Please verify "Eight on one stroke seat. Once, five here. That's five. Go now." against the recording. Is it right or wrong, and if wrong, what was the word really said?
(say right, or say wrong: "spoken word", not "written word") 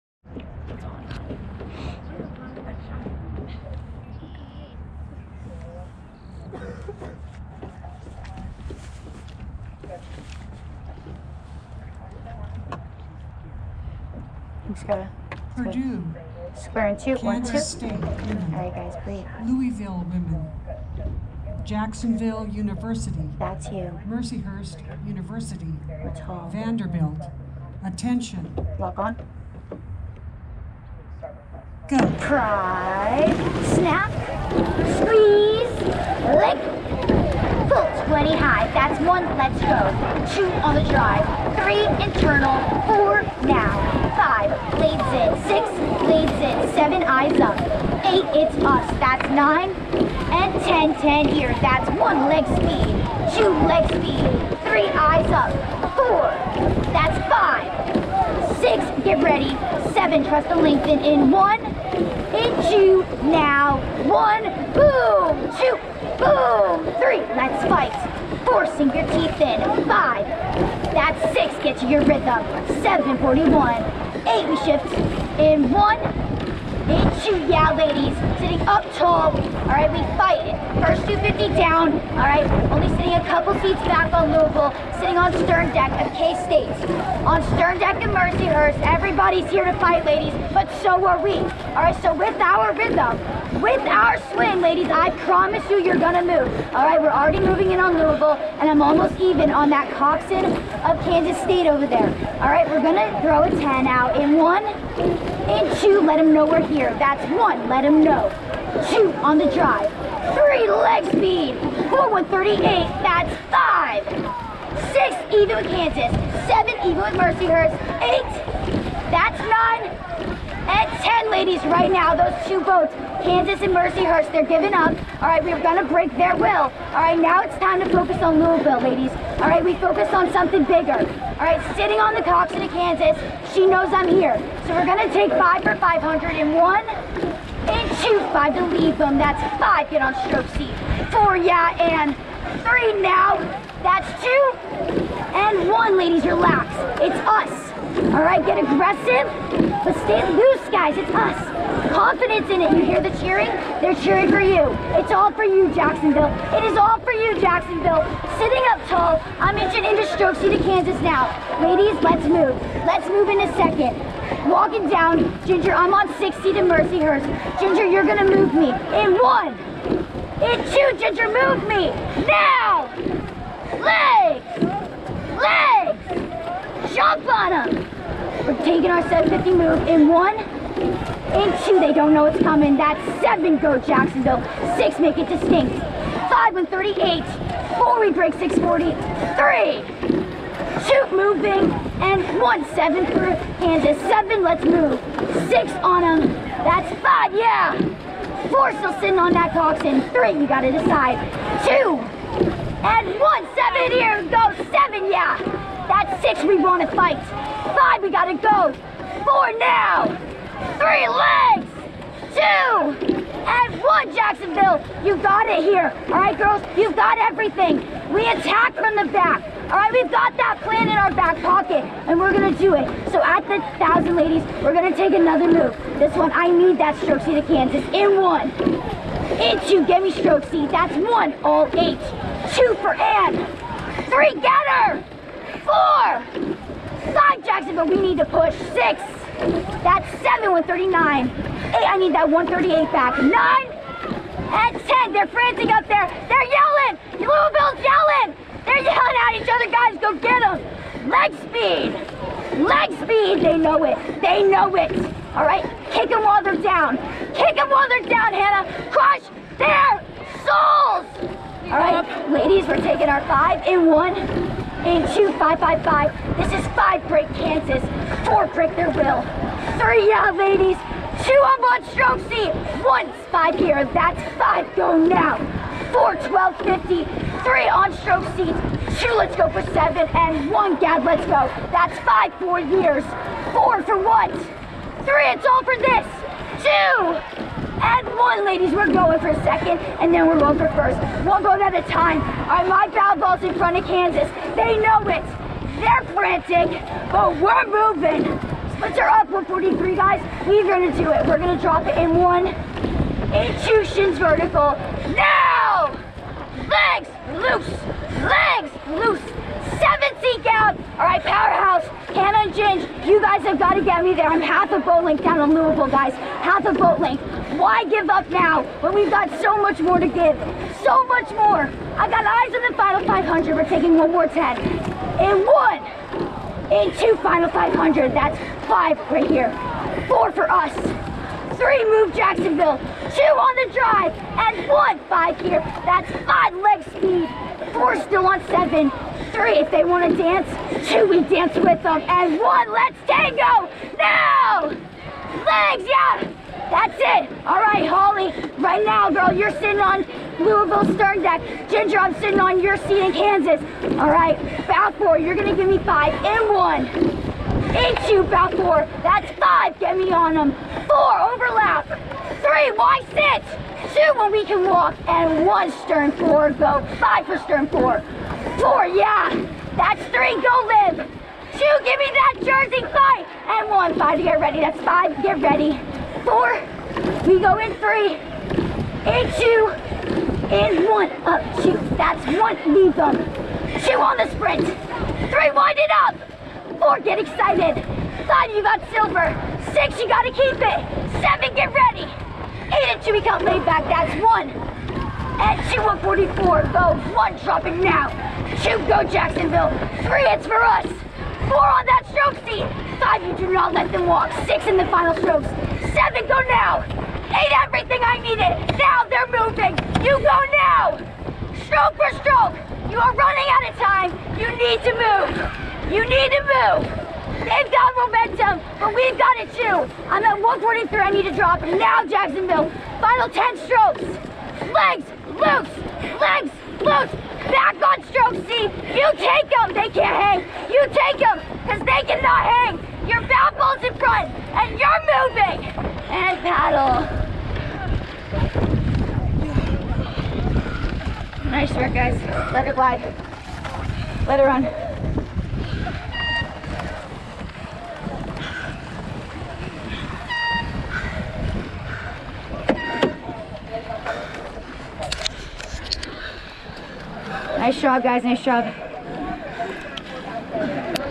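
wrong: "Two", not "Eight".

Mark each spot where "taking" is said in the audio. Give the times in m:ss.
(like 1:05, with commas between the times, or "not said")
2:58, 4:22, 5:23.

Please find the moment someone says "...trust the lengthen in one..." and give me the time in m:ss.
1:00.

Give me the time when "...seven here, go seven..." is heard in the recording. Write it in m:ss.
3:23.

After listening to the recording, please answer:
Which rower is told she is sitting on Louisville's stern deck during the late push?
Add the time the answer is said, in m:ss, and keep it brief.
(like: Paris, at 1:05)
Holly, at 5:47.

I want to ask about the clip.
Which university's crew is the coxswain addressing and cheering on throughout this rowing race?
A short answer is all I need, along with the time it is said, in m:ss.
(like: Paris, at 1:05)
Jacksonville University, at 0:21.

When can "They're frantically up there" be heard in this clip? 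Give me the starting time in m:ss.
4:05.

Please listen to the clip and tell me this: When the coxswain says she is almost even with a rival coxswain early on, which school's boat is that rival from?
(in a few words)
Kansas State.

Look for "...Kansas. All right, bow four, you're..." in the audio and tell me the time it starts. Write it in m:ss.
5:53.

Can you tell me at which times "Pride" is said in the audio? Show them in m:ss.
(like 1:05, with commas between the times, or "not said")
0:32.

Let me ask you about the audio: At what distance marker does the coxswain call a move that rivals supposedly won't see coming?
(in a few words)
750.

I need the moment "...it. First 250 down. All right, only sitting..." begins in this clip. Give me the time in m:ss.
1:20.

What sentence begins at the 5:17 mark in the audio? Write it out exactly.
Why give up now when we've got so much more to give?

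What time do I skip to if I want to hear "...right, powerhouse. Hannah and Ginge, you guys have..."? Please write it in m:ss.
5:11.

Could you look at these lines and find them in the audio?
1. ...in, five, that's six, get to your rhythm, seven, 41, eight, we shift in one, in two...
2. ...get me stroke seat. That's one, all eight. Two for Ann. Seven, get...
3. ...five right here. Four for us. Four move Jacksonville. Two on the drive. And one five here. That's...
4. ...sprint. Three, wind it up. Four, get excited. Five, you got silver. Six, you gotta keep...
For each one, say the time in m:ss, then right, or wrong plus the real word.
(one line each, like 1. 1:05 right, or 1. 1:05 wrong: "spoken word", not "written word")
1. 1:09 right
2. 3:49 wrong: "Three", not "Seven"
3. 5:28 wrong: "Three", not "Four"
4. 6:24 right.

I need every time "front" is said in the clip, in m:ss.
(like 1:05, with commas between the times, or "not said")
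4:53, 7:13.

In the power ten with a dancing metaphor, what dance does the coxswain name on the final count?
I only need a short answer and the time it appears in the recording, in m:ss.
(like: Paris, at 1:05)
Tango, at 5:43.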